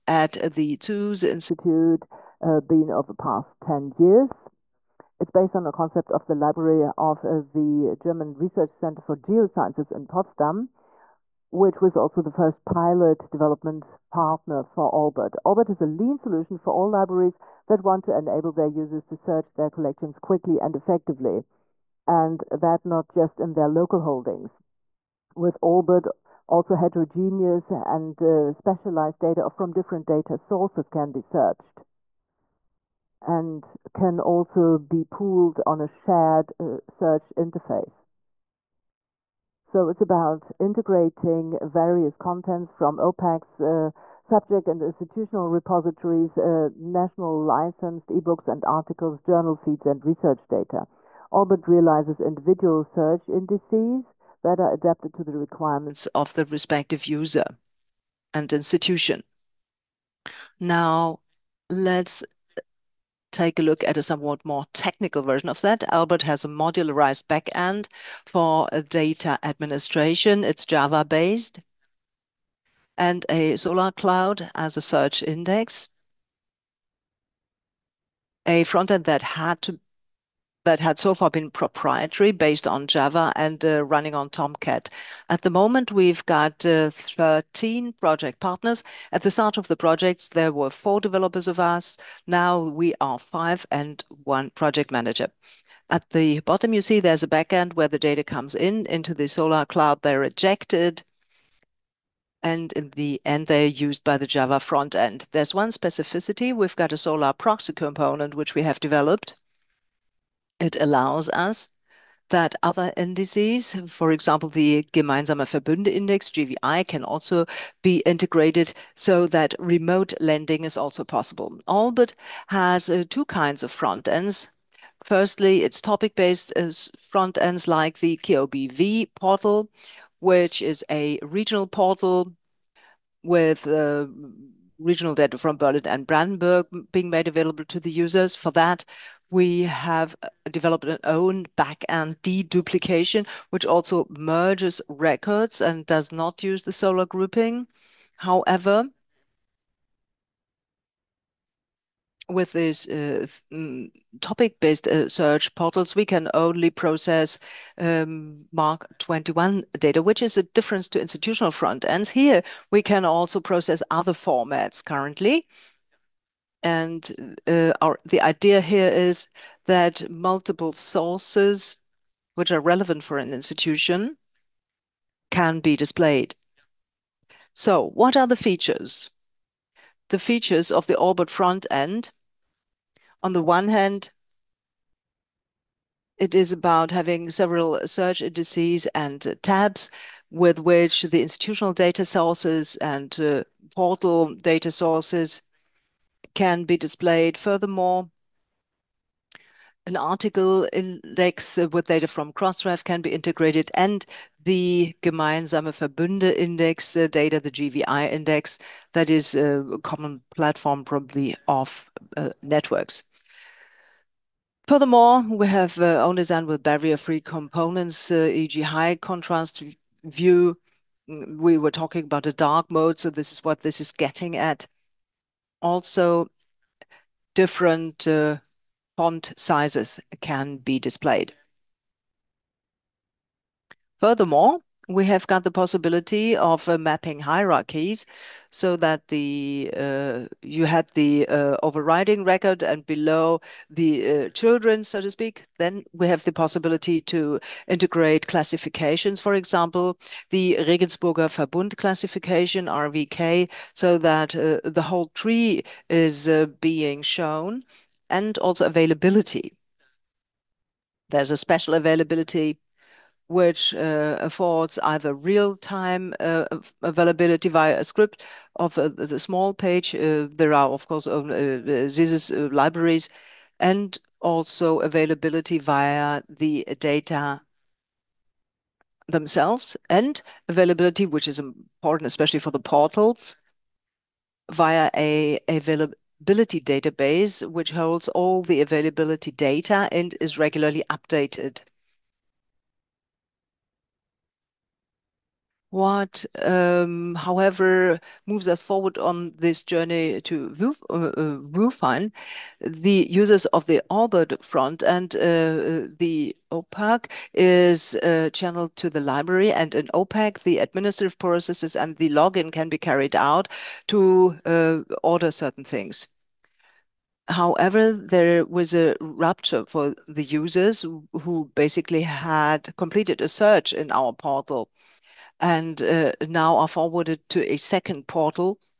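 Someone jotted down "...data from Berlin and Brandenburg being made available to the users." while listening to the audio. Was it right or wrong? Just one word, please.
right.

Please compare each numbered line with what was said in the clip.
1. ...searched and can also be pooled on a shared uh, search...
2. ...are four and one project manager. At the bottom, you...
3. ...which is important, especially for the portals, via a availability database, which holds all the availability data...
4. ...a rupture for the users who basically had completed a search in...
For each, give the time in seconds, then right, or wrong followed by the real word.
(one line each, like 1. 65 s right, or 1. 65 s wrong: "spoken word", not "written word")
1. 31 s right
2. 92 s wrong: "five", not "four"
3. 281 s right
4. 318 s right.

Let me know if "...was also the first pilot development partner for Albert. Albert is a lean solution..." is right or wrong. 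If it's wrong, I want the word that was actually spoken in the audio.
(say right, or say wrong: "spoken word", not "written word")
right.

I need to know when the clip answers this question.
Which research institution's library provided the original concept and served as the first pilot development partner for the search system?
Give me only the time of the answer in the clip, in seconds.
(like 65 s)
7 s.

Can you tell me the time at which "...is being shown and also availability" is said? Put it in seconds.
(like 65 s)
255 s.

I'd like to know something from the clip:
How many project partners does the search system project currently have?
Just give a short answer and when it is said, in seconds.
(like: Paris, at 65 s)
13, at 86 s.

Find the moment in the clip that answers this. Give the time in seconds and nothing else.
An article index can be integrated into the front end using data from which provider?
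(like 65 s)
202 s.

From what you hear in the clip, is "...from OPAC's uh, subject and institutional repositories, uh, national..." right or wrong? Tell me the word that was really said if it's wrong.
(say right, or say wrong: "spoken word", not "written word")
right.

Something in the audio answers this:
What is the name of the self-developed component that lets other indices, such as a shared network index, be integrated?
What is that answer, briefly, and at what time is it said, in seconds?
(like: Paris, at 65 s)
Solr Proxy, at 106 s.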